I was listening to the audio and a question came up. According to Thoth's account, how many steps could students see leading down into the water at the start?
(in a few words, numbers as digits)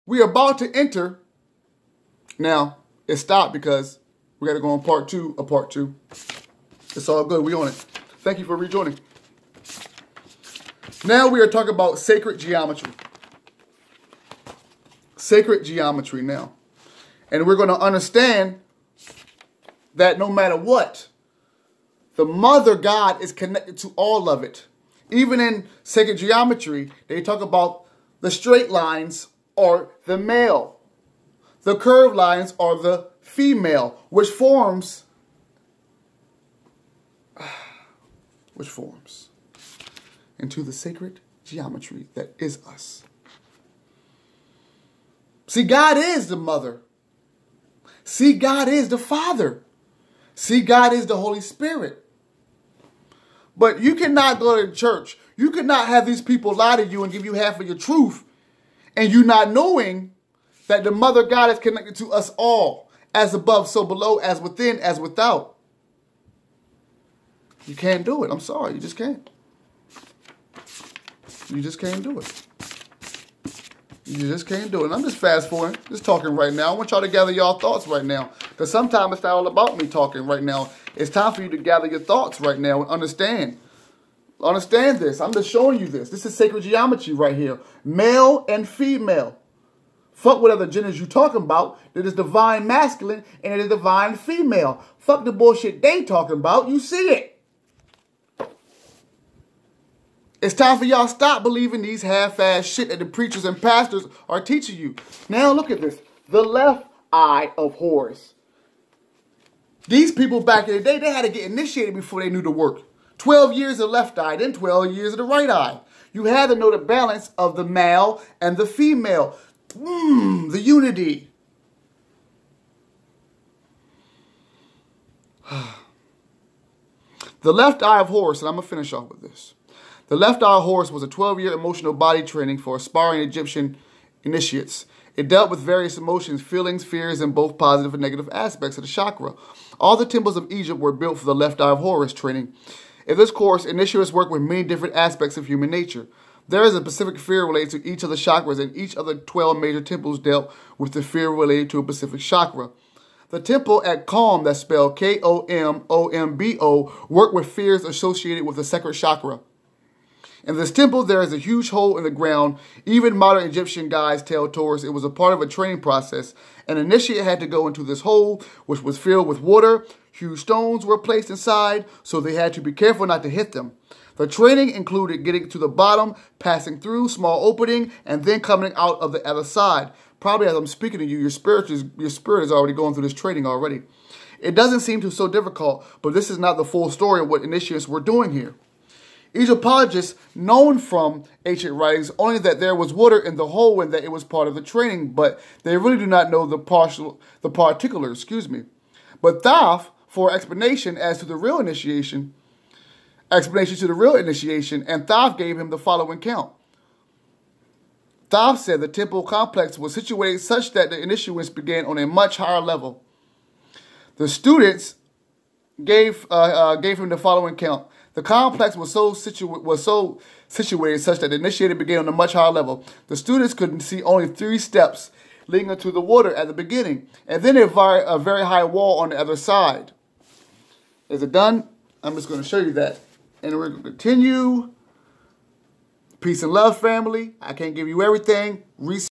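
3.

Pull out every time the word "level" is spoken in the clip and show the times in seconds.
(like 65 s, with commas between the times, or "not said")
212 s, 222 s.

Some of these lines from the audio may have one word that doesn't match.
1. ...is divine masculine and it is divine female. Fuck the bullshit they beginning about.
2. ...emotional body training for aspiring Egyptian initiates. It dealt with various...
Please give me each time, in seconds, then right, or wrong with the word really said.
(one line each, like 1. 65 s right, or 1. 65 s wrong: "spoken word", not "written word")
1. 92 s wrong: "talking", not "beginning"
2. 131 s right.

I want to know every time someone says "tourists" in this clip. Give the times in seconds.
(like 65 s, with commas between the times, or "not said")
164 s.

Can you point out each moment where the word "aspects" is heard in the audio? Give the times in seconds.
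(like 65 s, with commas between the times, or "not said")
138 s, 144 s.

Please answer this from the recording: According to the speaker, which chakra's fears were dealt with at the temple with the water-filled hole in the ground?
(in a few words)
sacred chakra.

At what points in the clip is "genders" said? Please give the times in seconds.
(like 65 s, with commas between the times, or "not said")
90 s.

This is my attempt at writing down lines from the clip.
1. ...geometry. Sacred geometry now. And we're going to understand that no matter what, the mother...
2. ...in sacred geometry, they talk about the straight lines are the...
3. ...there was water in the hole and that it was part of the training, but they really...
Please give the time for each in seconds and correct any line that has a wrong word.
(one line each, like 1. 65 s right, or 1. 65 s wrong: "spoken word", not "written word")
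1. 12 s right
2. 25 s right
3. 192 s right.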